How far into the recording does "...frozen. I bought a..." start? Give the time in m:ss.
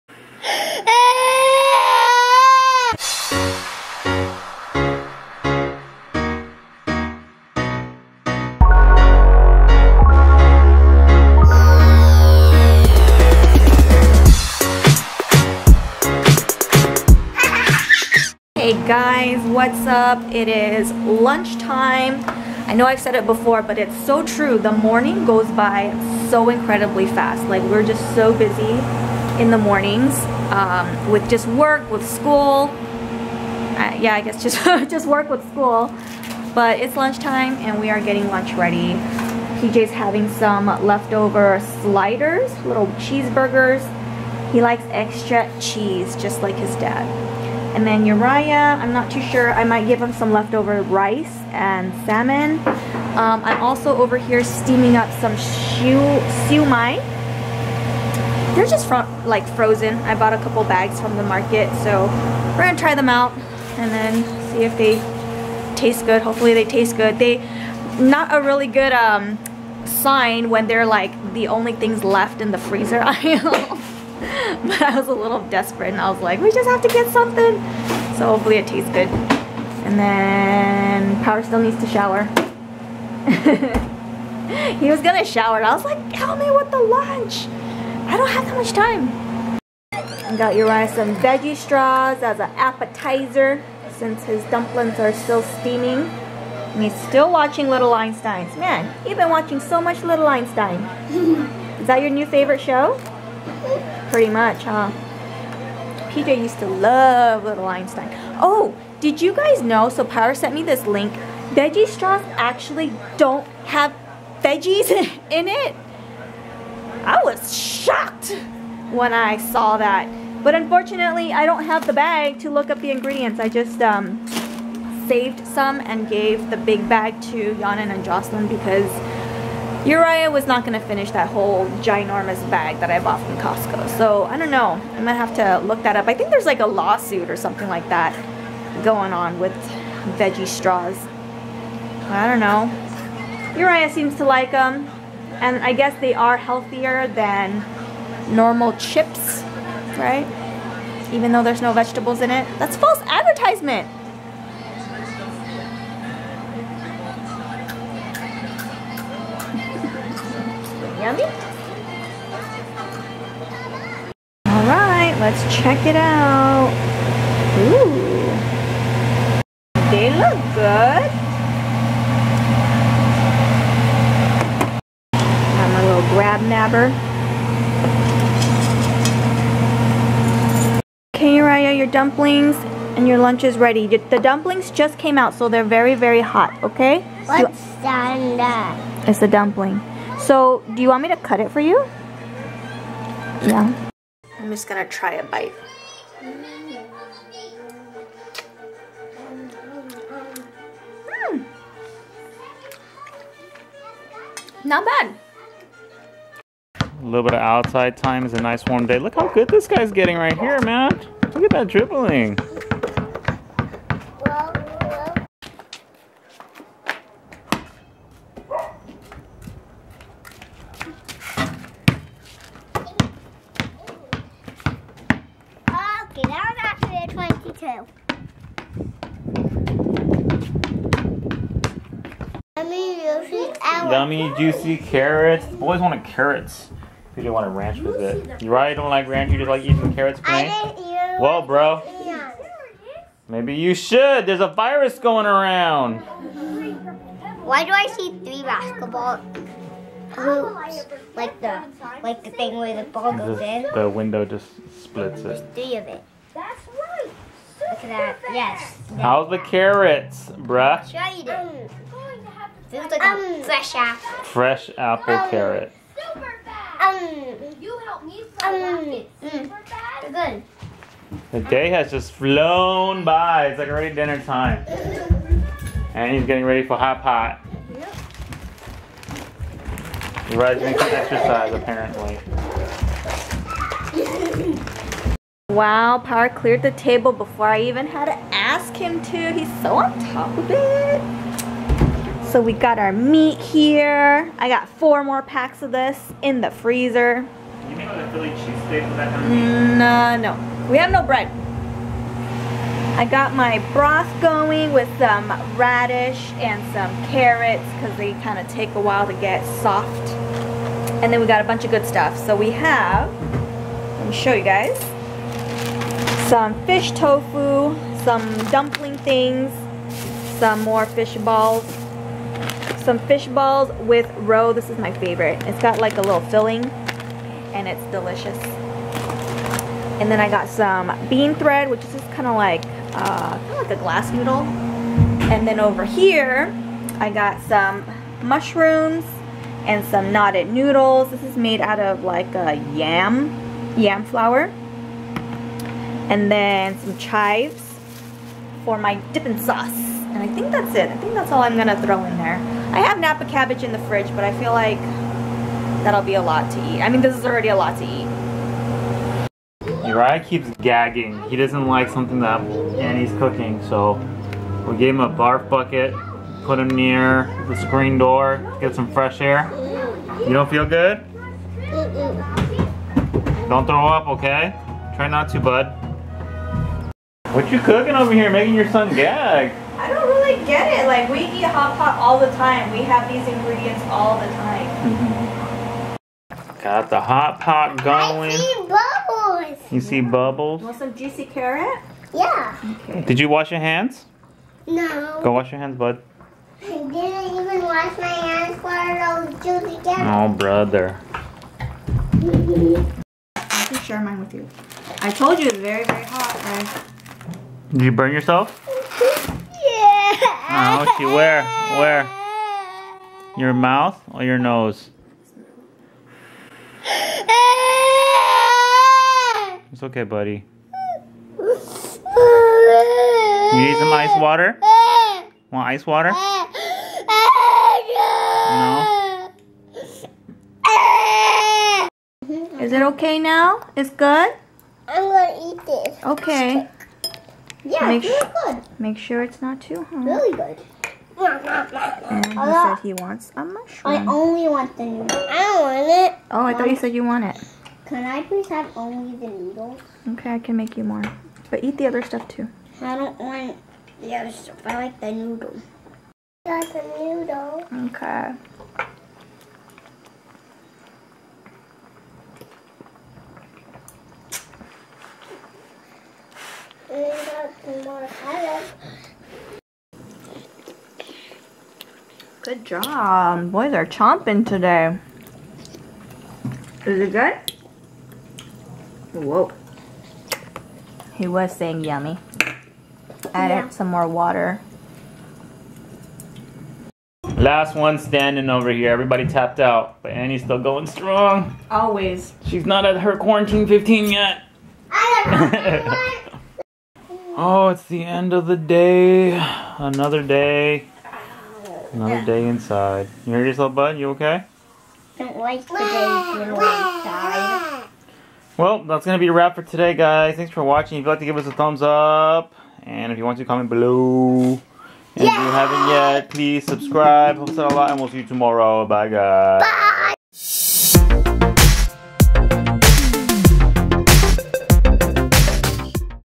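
0:59.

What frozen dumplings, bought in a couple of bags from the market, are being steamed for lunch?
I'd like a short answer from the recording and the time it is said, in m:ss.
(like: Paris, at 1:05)
siu mai, at 0:55.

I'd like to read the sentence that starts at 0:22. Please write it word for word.
I know I've said it before, but it's so true.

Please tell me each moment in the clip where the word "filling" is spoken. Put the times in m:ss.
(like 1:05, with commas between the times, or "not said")
5:26.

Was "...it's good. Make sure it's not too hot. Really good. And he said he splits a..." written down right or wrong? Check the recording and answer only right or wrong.
wrong.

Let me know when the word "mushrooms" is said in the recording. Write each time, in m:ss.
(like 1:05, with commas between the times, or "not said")
5:38, 7:23.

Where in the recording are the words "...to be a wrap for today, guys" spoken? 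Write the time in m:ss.
8:29.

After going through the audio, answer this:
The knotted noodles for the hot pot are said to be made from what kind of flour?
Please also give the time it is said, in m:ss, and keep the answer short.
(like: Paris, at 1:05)
yam flour, at 5:43.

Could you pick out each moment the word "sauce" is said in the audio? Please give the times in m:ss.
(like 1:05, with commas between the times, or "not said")
5:49.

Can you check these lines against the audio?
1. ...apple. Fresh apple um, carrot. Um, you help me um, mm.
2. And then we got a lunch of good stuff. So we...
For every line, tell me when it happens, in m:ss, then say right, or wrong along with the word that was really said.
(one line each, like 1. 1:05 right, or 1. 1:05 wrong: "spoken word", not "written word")
1. 4:23 right
2. 5:11 wrong: "bunch", not "lunch".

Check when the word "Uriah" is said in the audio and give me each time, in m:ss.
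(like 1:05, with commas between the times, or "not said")
0:48, 1:30, 2:09, 2:23, 5:59.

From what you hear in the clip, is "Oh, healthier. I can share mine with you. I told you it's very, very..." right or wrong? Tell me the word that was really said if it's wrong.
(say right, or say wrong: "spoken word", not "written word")
wrong: "brother", not "healthier".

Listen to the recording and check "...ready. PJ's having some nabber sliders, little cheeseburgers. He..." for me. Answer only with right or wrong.
wrong.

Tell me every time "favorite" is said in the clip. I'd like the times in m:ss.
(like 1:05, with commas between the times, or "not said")
1:42, 5:24.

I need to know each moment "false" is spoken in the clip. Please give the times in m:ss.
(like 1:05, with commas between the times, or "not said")
2:32.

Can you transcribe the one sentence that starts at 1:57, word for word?
I was shocked when I saw that.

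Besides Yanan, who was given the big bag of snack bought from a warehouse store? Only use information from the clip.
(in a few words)
Jocelyn.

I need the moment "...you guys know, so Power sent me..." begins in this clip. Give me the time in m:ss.
1:49.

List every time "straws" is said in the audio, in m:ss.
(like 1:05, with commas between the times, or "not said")
1:31, 1:51, 2:20.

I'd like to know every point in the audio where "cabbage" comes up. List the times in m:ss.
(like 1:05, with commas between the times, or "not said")
5:53.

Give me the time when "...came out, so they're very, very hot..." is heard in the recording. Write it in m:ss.
3:04.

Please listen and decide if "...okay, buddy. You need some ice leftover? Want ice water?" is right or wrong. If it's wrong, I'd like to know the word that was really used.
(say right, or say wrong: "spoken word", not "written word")
wrong: "water", not "leftover".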